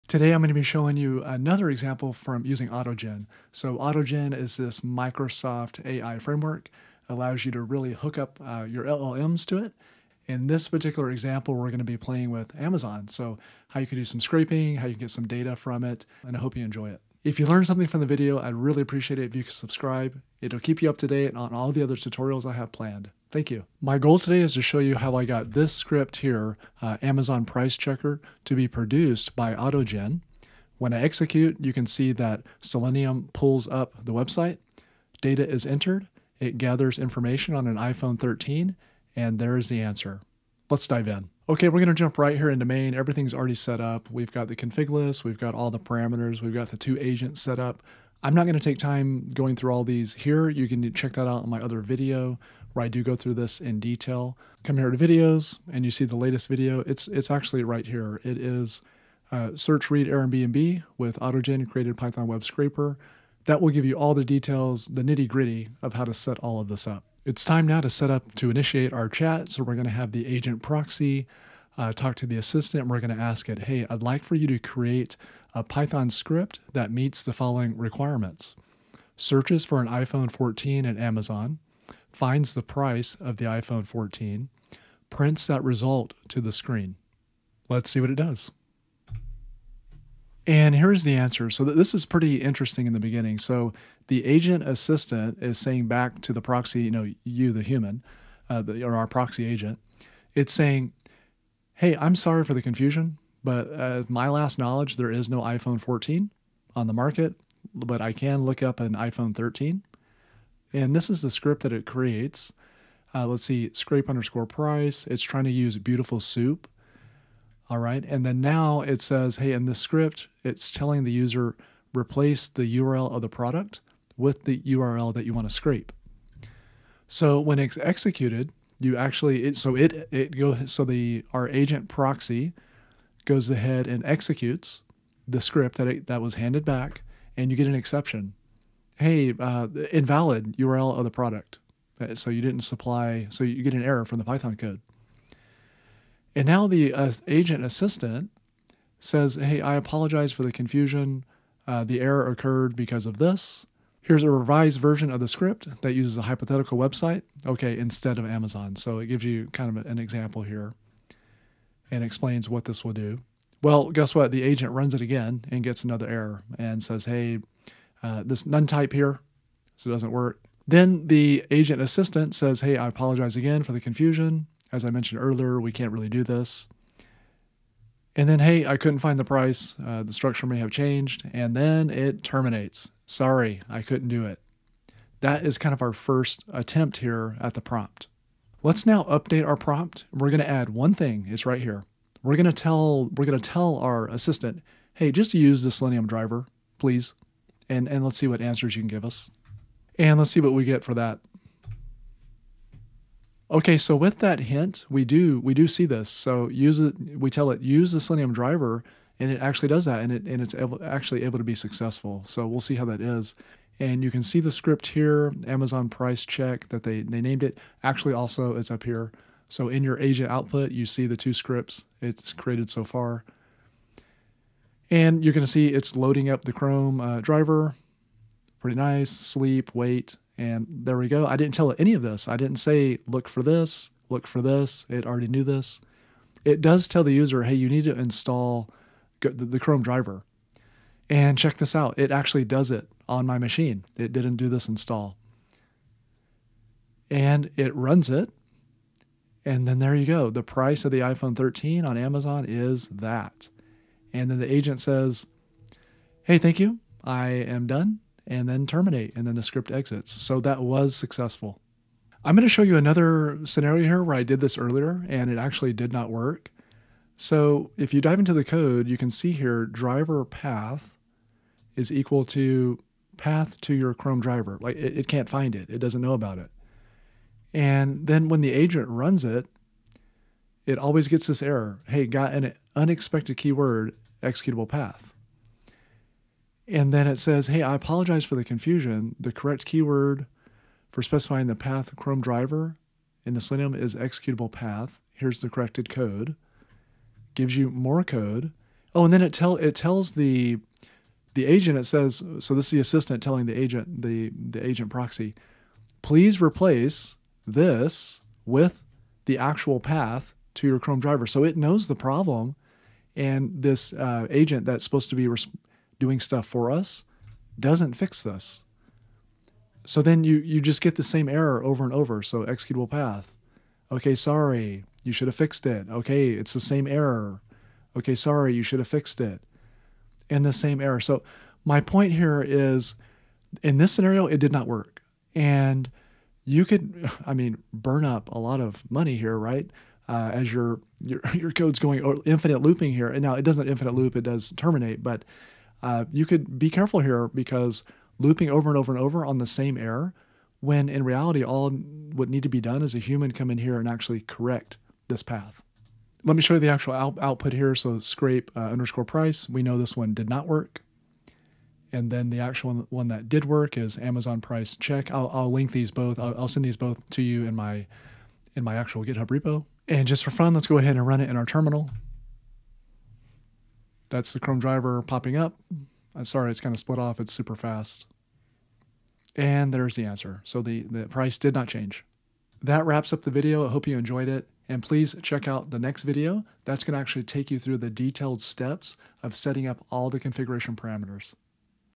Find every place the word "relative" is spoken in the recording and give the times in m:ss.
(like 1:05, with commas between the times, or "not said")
not said.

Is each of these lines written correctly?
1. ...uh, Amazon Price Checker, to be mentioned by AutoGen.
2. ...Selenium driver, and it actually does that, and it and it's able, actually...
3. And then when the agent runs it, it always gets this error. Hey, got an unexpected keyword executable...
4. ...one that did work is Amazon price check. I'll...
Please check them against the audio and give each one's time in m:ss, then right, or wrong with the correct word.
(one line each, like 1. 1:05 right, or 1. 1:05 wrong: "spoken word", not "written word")
1. 0:26 wrong: "produced", not "mentioned"
2. 3:27 right
3. 4:37 right
4. 6:02 right.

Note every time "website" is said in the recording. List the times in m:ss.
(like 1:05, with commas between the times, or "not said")
0:34, 2:36.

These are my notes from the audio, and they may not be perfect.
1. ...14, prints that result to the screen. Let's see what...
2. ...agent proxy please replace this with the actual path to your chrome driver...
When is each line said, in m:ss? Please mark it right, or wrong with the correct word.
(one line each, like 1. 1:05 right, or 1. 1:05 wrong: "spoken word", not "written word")
1. 1:23 right
2. 5:04 right.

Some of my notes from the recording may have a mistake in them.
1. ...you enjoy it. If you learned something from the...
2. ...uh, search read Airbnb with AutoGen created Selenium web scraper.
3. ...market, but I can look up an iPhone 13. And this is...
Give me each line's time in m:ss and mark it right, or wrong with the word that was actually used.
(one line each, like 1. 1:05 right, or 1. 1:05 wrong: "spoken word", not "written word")
1. 0:16 right
2. 0:59 wrong: "Python", not "Selenium"
3. 1:46 right.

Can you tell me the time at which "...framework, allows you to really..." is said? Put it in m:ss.
0:06.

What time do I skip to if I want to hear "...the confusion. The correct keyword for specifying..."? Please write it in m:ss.
4:48.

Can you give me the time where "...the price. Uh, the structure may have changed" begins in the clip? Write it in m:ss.
2:59.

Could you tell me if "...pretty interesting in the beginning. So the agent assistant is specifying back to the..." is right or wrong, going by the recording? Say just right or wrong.
wrong.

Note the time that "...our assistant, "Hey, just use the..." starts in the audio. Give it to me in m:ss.
3:13.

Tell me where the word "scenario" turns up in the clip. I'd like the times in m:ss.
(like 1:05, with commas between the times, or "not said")
4:23, 5:33.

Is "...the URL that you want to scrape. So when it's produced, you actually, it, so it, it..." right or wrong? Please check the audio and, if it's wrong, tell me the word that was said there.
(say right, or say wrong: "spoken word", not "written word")
wrong: "executed", not "produced".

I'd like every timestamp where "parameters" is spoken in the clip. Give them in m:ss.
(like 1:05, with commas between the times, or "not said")
0:45, 6:30.